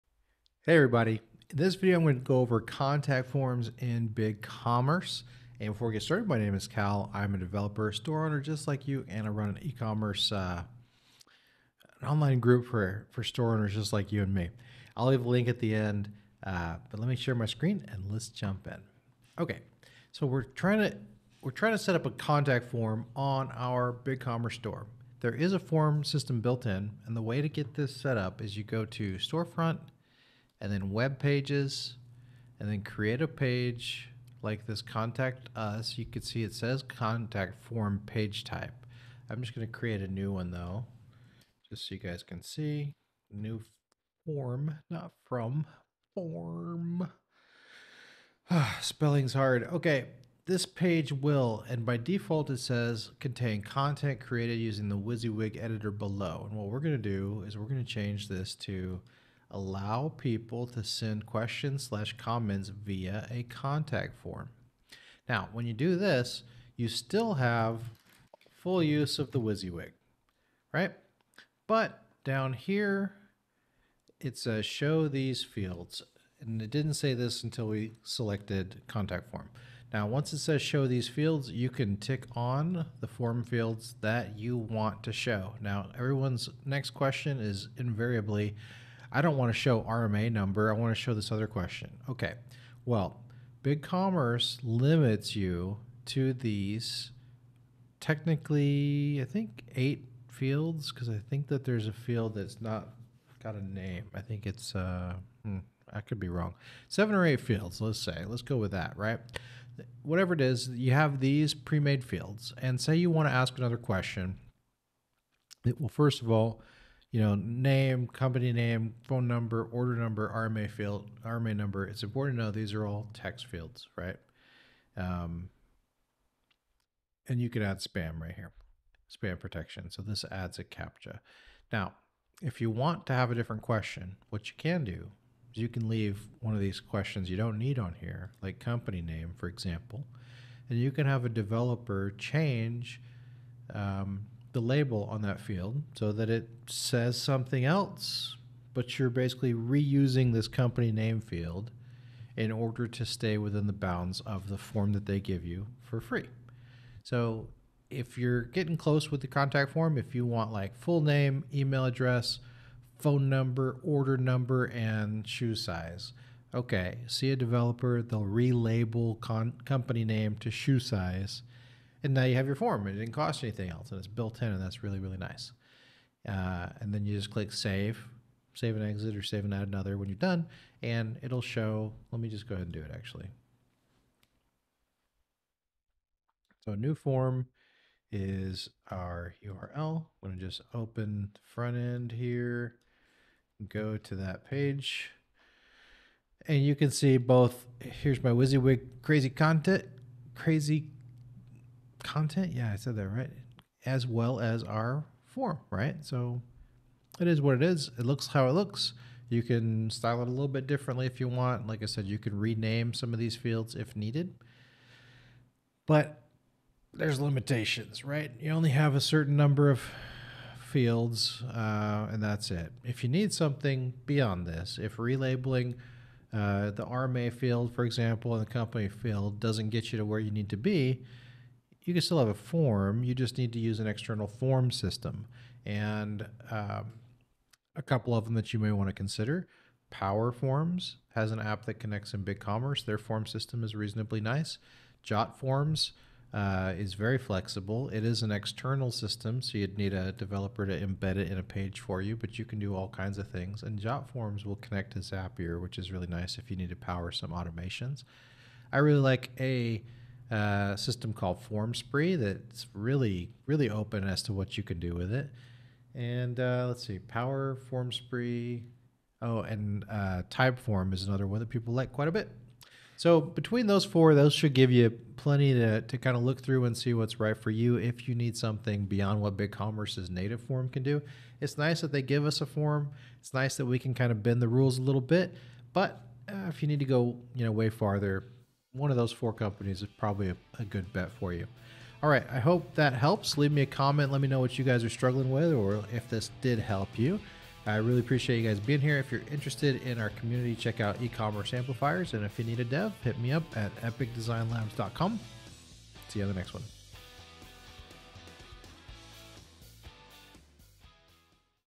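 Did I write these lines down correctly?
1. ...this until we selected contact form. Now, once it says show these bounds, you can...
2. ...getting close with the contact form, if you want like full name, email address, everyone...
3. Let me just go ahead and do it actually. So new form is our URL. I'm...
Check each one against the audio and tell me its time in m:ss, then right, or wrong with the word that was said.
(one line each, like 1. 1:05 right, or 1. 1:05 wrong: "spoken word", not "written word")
1. 1:17 wrong: "fields", not "bounds"
2. 2:38 wrong: "phone", not "everyone"
3. 3:02 right.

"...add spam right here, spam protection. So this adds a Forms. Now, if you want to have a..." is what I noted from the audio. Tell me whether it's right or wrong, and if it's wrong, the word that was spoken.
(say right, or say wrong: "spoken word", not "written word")
wrong: "CAPTCHA", not "Forms".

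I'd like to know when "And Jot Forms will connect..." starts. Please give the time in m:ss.
4:13.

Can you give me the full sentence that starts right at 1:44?
I think it's, uh, hmm, I could be wrong.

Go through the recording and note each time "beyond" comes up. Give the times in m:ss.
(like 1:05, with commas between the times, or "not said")
3:44, 4:38.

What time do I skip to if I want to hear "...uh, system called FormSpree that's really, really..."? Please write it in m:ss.
4:20.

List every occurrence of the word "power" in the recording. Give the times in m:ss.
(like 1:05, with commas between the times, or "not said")
3:59, 4:16, 4:26.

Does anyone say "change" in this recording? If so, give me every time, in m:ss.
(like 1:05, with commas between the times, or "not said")
0:57, 2:22.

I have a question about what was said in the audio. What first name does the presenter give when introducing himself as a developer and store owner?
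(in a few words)
Kal.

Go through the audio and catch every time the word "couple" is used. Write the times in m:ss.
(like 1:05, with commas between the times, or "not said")
3:57.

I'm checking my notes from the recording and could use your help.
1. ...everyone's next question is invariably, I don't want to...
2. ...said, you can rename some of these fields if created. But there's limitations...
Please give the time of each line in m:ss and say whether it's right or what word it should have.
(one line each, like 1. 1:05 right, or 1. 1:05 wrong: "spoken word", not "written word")
1. 1:25 right
2. 3:31 wrong: "needed", not "created".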